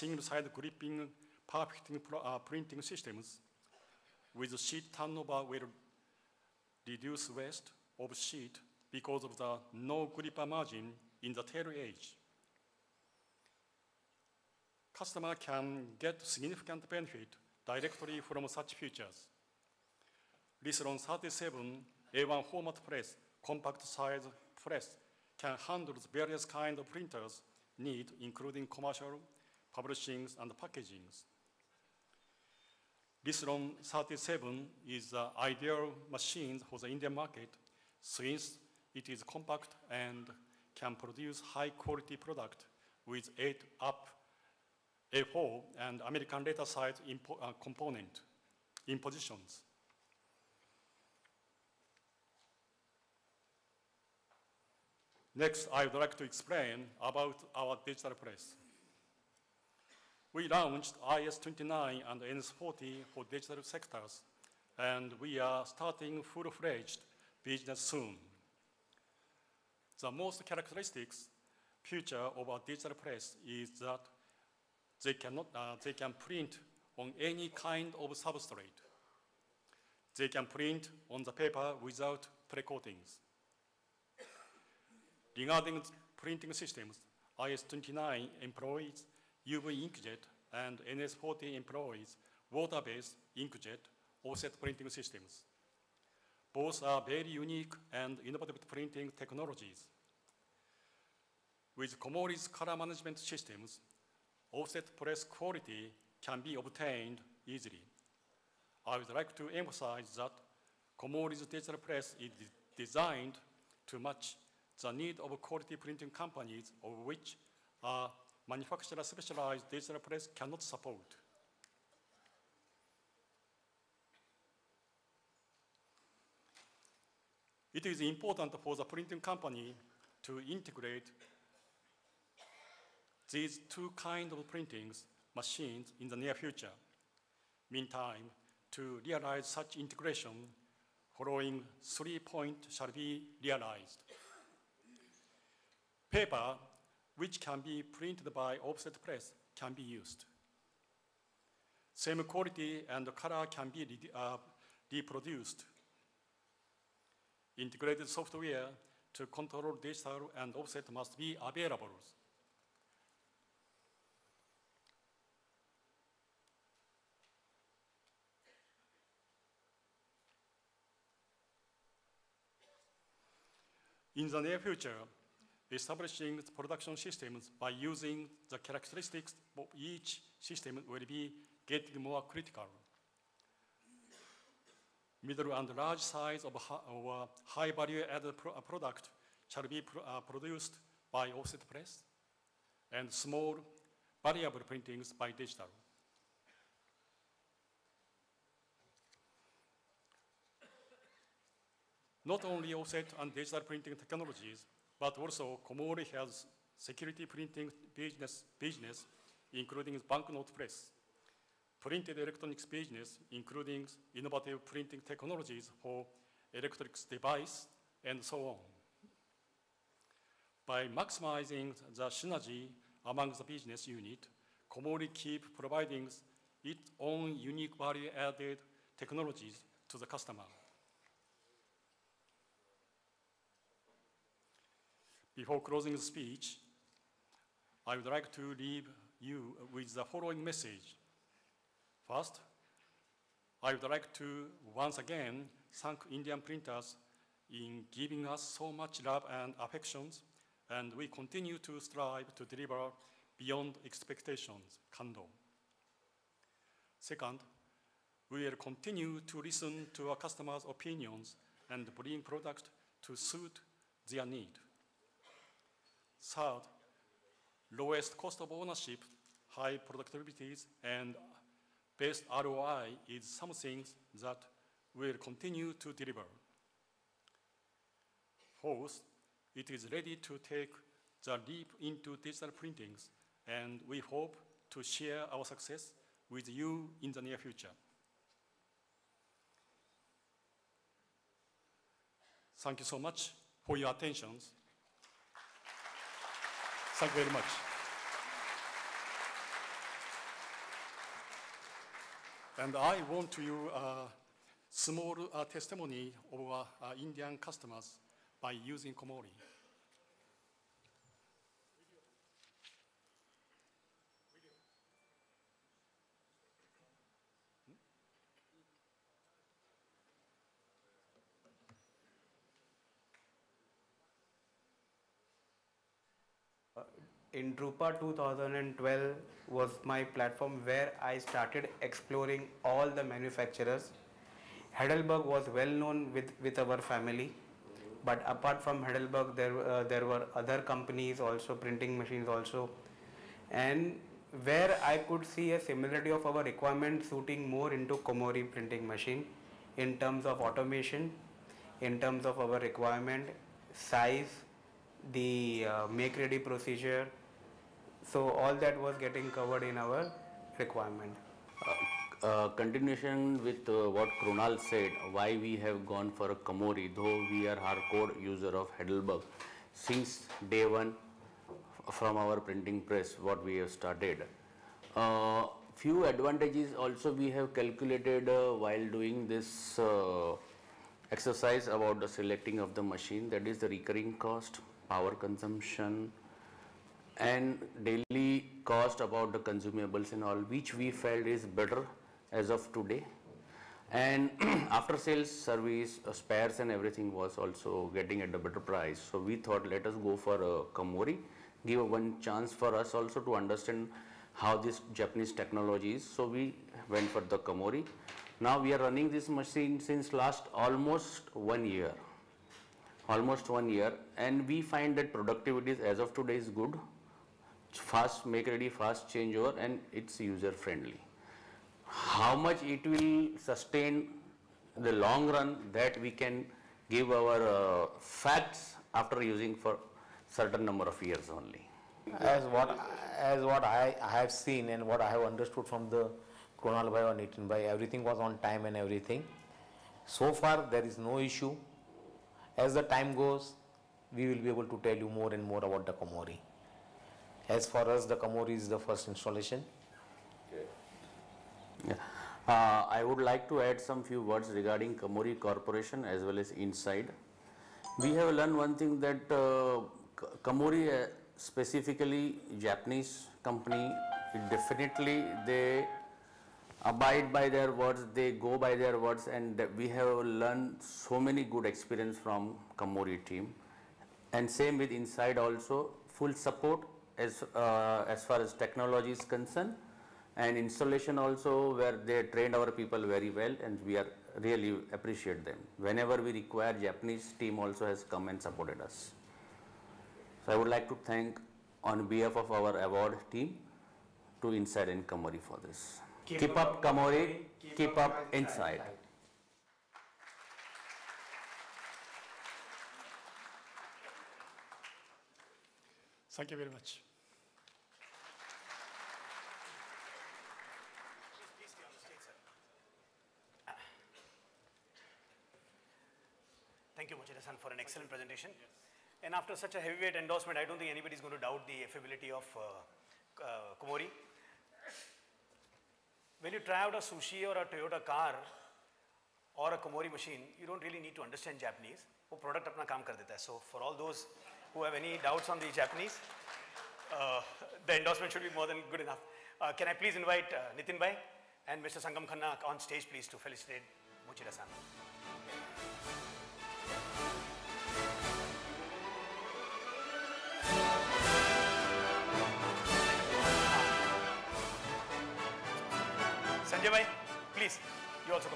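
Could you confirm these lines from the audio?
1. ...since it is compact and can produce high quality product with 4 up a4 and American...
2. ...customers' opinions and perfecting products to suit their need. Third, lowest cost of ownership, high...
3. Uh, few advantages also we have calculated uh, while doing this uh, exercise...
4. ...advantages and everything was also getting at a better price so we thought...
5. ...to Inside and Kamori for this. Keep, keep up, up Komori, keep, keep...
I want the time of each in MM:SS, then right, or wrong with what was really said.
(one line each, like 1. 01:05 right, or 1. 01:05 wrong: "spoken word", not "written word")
1. 00:38 wrong: "8", not "4"
2. 04:20 wrong: "bring", not "perfecting"
3. 06:14 right
4. 06:36 wrong: "spares", not "advantages"
5. 08:14 wrong: "Kamori", not "Komori".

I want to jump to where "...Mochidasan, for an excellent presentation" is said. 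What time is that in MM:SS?
08:37.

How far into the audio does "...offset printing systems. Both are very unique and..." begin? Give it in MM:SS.
01:34.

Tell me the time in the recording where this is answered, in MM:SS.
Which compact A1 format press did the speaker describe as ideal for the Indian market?
00:33.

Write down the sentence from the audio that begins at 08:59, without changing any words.
Uh, can I please invite uh, Nitin Bhai and Mr.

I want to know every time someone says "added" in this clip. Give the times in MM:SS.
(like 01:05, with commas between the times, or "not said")
03:08, 03:47.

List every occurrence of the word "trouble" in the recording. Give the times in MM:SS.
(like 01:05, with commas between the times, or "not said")
not said.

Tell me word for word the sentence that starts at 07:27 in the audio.
As for us, the Kamori is the first installation.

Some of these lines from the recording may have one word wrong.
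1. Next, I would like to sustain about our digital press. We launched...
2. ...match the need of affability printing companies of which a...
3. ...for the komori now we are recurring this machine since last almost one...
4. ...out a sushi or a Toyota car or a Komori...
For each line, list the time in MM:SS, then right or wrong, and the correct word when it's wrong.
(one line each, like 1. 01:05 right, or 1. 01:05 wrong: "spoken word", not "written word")
1. 00:55 wrong: "explain", not "sustain"
2. 01:53 wrong: "quality", not "affability"
3. 06:47 wrong: "running", not "recurring"
4. 08:46 right.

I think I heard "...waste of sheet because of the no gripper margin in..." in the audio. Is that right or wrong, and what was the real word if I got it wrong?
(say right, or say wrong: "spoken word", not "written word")
right.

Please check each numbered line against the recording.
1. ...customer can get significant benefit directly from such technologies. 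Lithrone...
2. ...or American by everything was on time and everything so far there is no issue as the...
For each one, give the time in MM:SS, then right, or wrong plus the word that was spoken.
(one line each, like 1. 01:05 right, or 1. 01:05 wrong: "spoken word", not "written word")
1. 00:14 wrong: "features", not "technologies"
2. 07:17 wrong: "Nitin", not "American".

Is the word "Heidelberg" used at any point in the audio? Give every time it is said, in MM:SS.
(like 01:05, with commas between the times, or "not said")
05:34, 05:38, 06:08.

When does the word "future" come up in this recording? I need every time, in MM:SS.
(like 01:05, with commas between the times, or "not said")
02:16, 02:54, 04:47.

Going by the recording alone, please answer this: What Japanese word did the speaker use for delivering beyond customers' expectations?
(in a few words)
Kando.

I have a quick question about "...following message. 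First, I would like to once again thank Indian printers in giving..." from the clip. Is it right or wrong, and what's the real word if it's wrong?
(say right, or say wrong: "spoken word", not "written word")
right.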